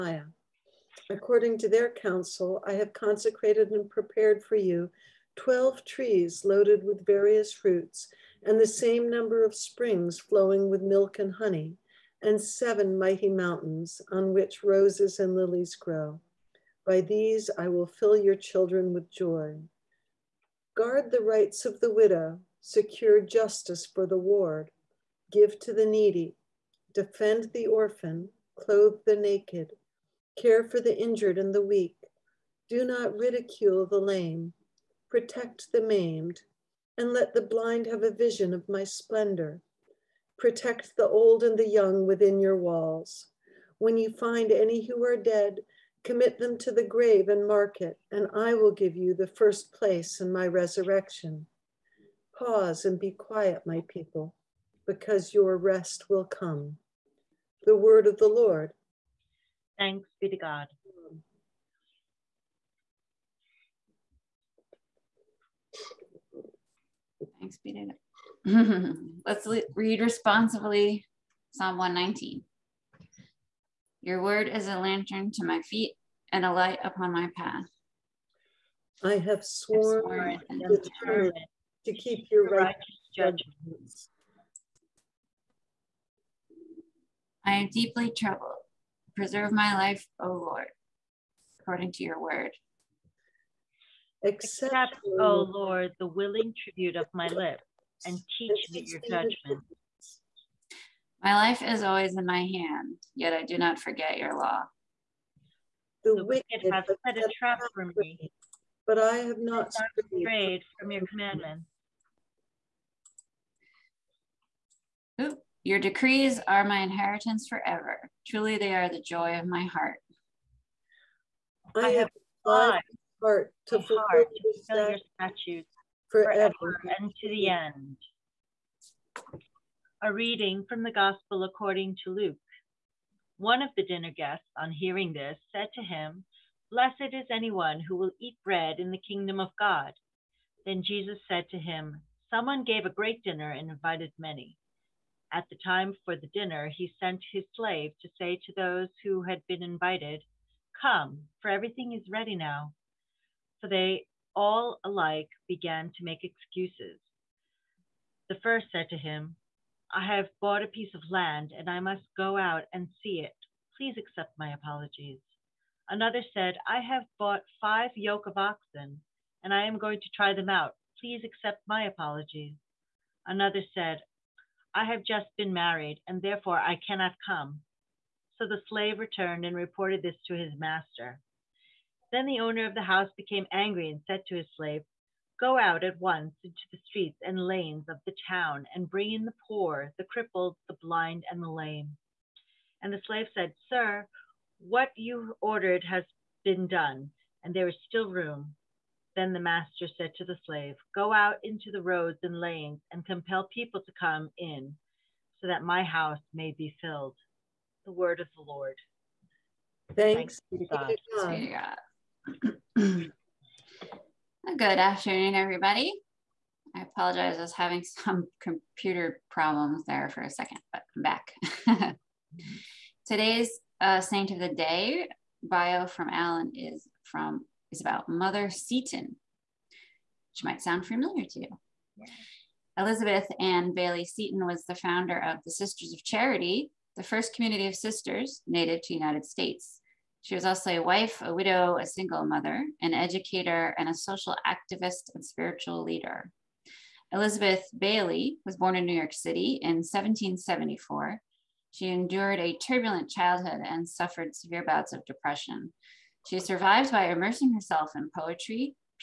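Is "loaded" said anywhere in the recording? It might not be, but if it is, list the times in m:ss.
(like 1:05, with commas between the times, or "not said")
0:06.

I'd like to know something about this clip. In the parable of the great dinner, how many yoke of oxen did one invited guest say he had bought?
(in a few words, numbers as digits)
5.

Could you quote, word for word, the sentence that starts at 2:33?
So they all alike began to make excuses.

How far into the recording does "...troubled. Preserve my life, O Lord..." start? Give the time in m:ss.
1:28.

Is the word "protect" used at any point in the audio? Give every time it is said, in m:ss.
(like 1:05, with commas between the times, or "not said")
0:35, 0:40.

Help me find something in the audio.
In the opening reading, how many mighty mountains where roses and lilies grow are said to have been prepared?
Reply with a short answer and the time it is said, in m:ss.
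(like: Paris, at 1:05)
7, at 0:12.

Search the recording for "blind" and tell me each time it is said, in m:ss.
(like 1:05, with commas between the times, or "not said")
0:37, 3:10.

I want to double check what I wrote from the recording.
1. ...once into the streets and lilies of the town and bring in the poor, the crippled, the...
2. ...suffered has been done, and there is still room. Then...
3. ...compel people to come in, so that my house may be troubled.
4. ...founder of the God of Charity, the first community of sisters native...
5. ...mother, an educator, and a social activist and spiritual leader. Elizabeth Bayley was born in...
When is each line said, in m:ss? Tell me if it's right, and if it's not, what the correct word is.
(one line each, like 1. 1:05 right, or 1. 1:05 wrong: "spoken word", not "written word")
1. 3:06 wrong: "lanes", not "lilies"
2. 3:15 wrong: "ordered", not "suffered"
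3. 3:23 wrong: "filled", not "troubled"
4. 3:54 wrong: "Sisters", not "God"
5. 4:02 right.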